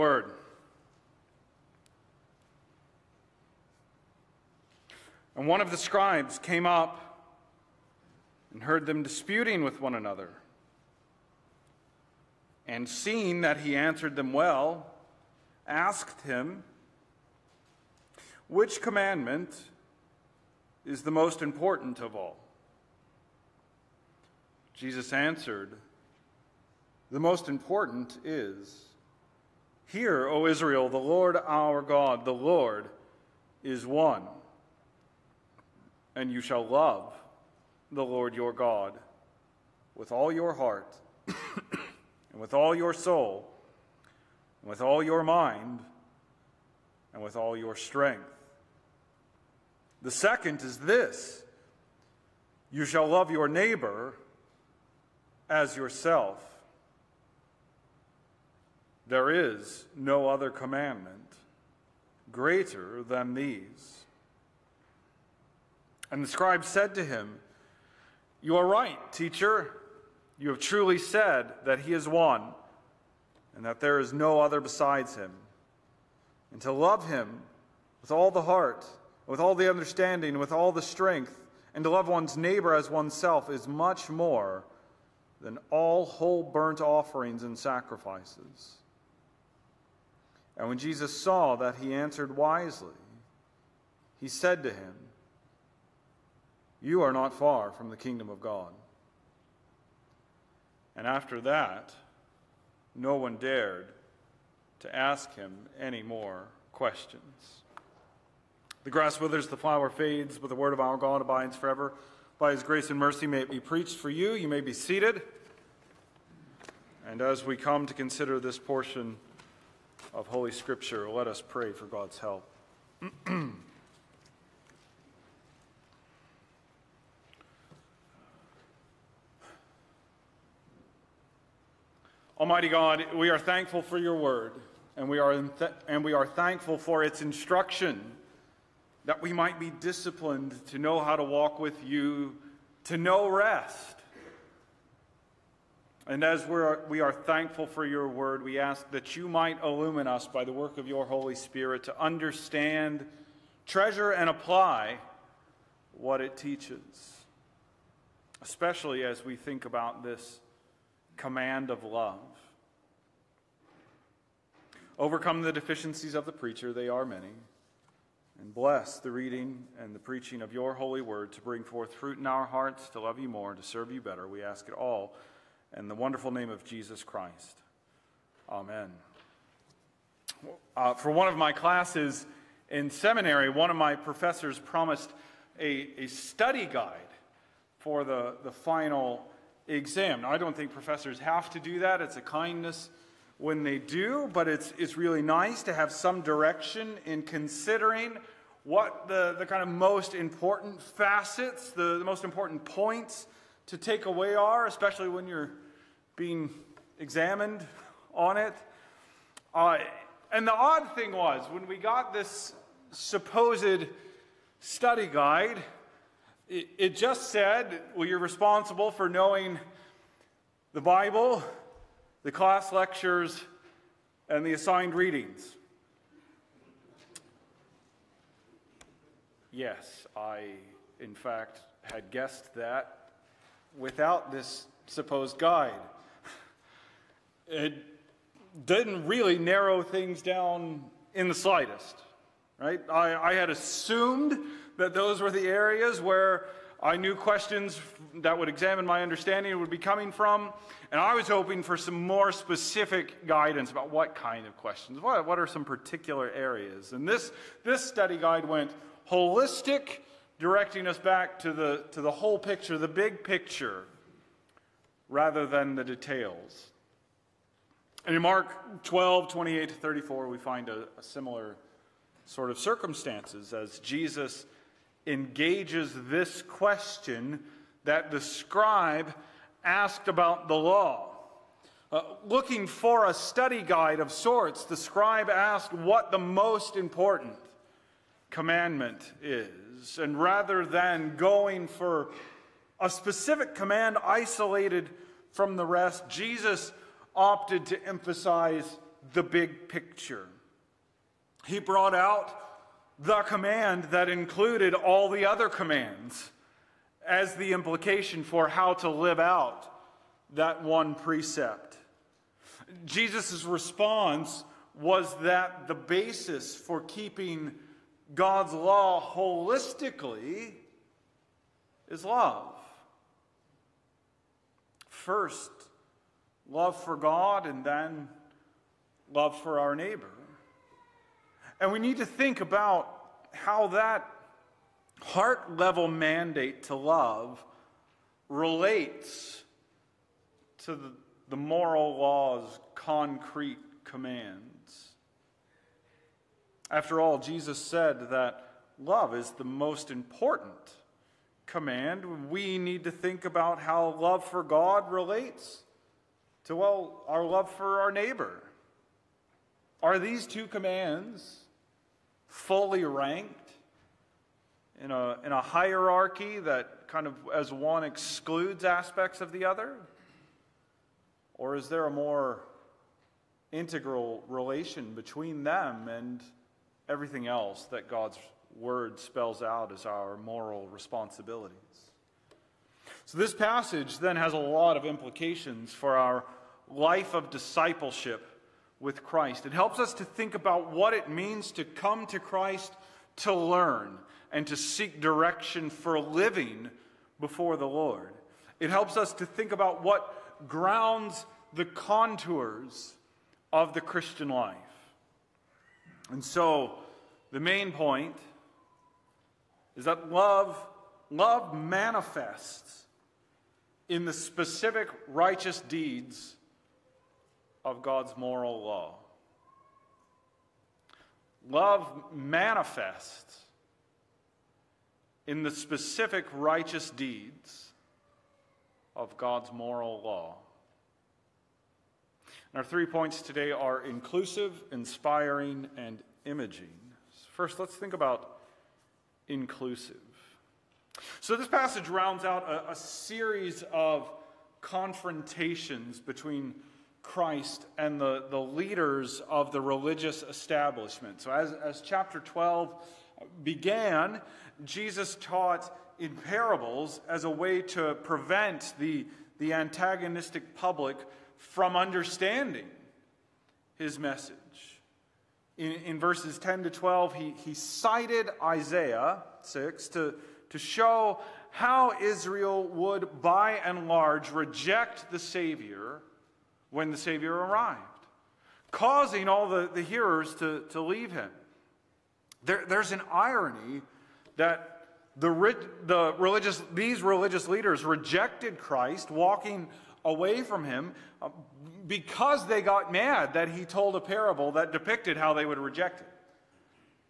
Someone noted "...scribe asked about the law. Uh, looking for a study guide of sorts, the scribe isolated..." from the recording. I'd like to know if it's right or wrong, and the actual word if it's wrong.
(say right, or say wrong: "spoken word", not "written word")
wrong: "asked", not "isolated".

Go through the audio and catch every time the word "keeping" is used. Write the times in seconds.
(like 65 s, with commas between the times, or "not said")
316 s.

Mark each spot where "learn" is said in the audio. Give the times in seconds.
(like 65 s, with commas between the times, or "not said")
393 s.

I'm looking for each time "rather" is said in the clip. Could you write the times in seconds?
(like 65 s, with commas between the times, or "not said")
265 s, 290 s.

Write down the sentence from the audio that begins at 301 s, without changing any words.
He brought out the command that included all the other commands as the implication for how to live out that one precept.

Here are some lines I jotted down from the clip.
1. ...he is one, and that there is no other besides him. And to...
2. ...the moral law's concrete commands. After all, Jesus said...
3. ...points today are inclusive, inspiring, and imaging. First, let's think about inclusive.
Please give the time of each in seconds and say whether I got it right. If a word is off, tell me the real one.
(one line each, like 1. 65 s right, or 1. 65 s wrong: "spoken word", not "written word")
1. 71 s right
2. 341 s right
3. 432 s right.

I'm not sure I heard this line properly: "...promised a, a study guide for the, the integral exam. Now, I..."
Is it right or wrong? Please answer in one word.
wrong.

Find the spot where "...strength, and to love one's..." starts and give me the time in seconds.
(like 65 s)
80 s.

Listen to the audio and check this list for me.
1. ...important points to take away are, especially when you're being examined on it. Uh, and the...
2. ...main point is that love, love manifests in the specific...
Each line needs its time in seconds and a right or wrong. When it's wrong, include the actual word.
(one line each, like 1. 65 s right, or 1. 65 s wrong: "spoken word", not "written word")
1. 202 s right
2. 407 s right.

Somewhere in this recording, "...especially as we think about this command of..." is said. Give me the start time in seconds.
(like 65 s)
158 s.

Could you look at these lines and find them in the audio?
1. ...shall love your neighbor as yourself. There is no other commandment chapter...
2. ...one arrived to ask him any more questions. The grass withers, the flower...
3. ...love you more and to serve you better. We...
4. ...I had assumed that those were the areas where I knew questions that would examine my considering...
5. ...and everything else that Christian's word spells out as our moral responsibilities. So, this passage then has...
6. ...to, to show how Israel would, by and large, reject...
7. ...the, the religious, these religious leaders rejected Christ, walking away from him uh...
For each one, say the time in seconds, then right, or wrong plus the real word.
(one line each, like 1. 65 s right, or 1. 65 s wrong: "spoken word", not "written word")
1. 52 s wrong: "greater", not "chapter"
2. 103 s wrong: "dared", not "arrived"
3. 172 s right
4. 243 s wrong: "understanding", not "considering"
5. 375 s wrong: "God", not "Christian"
6. 469 s right
7. 485 s right.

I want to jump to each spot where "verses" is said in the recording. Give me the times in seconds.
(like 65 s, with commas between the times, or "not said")
465 s.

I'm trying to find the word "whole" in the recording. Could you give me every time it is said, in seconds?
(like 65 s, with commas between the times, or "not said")
86 s, 262 s.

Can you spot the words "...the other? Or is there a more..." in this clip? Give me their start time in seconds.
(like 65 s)
369 s.